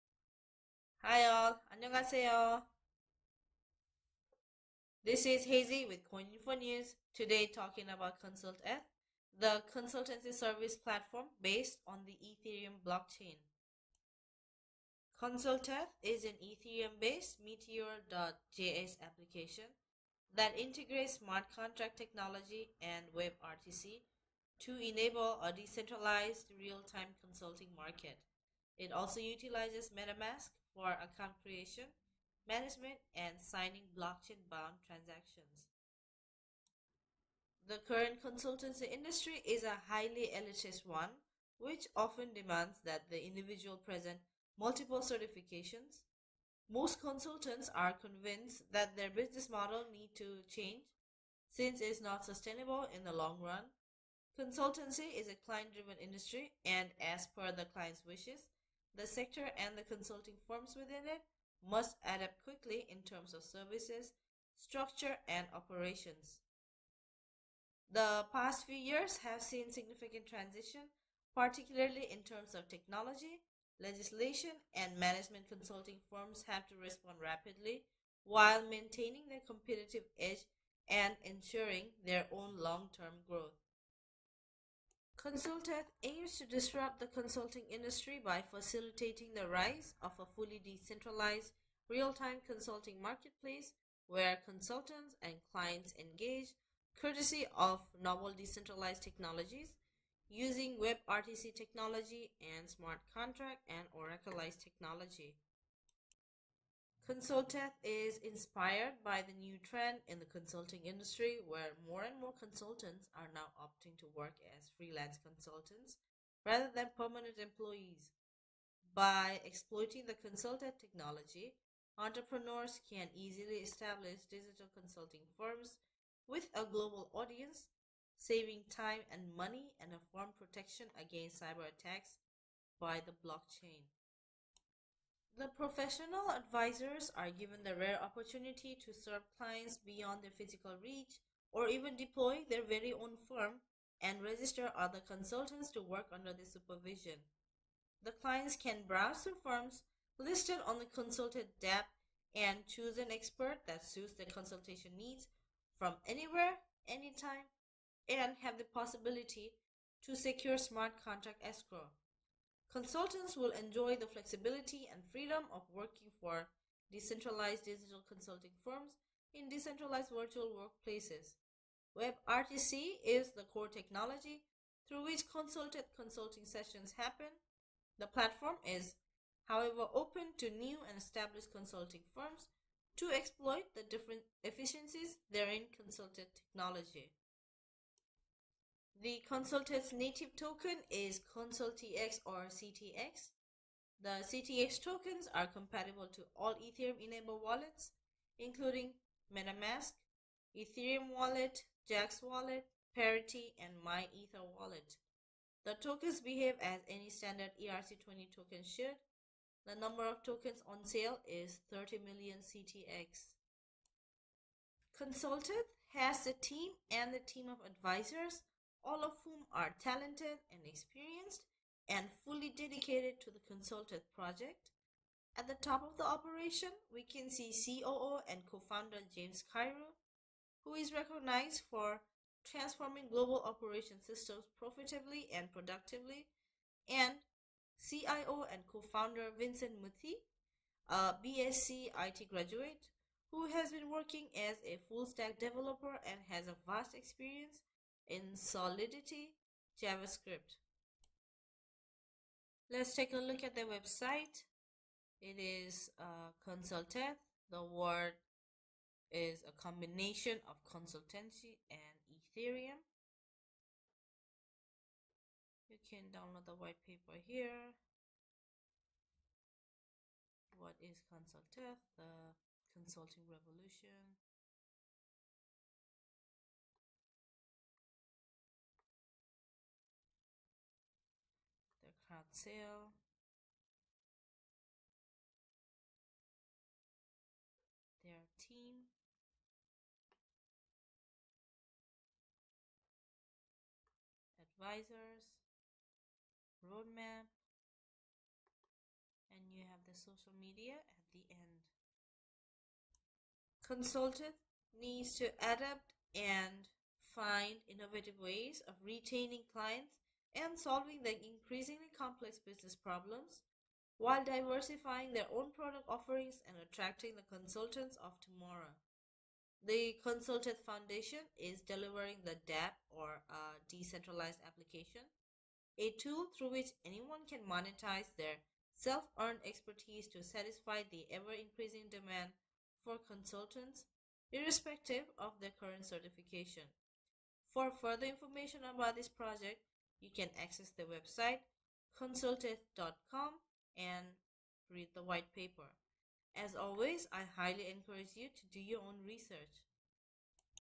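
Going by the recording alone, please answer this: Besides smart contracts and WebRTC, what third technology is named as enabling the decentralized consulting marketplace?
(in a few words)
Oraclize.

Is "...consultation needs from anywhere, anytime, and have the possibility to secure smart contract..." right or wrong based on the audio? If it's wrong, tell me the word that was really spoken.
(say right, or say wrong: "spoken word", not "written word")
right.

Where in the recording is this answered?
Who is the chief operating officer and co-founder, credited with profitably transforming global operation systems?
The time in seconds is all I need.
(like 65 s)
229 s.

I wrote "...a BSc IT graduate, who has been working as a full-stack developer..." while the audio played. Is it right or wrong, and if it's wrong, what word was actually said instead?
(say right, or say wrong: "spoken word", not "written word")
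right.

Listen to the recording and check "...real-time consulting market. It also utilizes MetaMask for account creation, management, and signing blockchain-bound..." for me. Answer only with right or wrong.
right.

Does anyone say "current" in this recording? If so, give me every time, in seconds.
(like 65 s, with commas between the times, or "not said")
37 s, 335 s.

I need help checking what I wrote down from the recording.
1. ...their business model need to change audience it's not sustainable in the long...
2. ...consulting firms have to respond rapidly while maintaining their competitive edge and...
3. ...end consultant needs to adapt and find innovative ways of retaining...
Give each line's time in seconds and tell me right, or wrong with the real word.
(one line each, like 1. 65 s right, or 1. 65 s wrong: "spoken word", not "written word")
1. 48 s wrong: "since", not "audience"
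2. 75 s right
3. 301 s right.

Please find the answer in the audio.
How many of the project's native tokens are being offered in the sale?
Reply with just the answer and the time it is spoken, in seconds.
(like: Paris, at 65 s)
30 million CTX, at 211 s.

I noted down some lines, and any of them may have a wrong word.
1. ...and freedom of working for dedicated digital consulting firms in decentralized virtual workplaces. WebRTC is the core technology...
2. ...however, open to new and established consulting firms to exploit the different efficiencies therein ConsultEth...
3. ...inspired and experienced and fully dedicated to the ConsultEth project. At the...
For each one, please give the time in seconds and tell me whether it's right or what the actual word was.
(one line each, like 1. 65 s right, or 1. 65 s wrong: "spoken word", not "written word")
1. 164 s wrong: "decentralized", not "dedicated"
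2. 179 s right
3. 219 s wrong: "talented", not "inspired".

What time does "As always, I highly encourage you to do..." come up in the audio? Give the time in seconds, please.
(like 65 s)
346 s.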